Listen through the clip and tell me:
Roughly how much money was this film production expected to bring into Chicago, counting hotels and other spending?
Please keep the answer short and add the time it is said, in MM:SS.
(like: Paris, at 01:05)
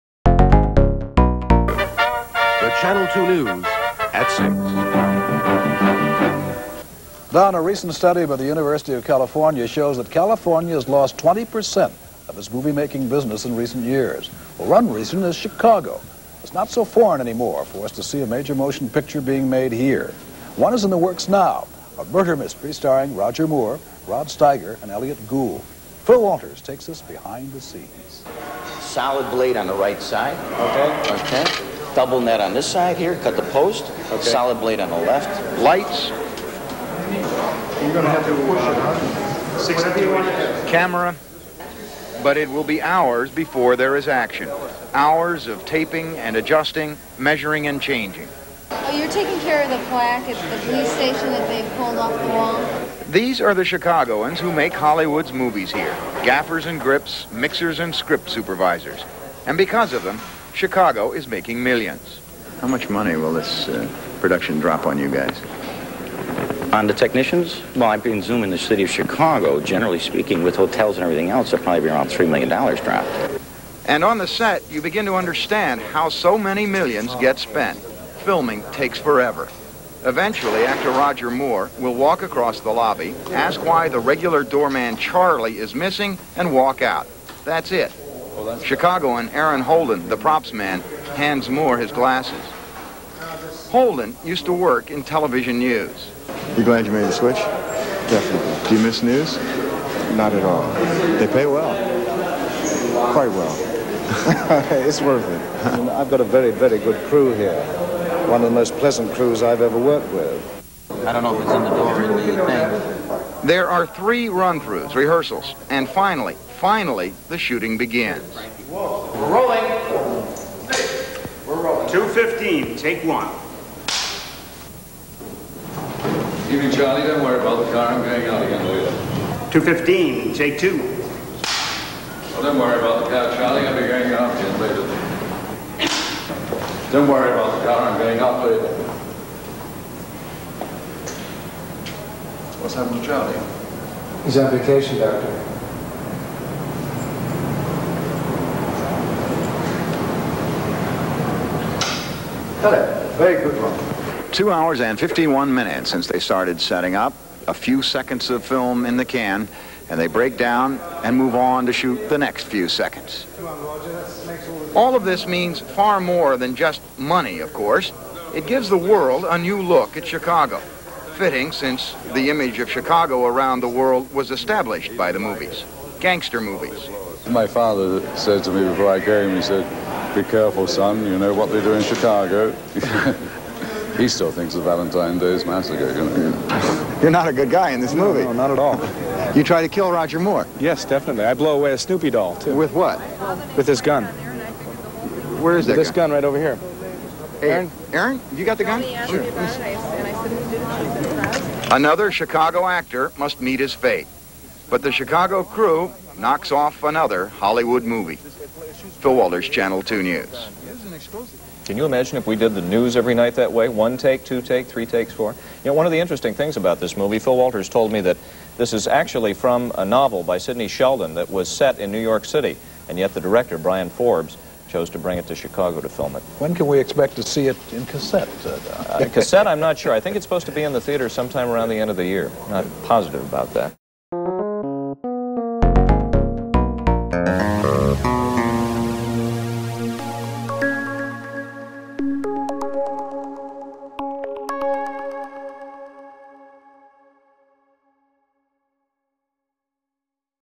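$3 million, at 01:12.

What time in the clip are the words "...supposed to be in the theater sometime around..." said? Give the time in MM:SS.
03:50.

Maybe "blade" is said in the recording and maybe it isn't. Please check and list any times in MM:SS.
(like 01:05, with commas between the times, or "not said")
00:29, 00:34.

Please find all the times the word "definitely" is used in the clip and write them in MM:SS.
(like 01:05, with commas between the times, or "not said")
01:37, 03:10.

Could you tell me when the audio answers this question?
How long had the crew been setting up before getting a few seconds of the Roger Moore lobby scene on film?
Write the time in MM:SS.
02:34.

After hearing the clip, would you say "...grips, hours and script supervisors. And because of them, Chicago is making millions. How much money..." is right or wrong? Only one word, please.
wrong.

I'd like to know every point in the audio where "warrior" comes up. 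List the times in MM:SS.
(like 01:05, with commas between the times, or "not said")
not said.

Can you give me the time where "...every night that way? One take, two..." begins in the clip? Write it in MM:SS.
03:32.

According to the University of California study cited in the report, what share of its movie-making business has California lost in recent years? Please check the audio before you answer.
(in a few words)
20%.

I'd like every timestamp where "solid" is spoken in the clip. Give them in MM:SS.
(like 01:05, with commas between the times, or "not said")
00:28, 00:34.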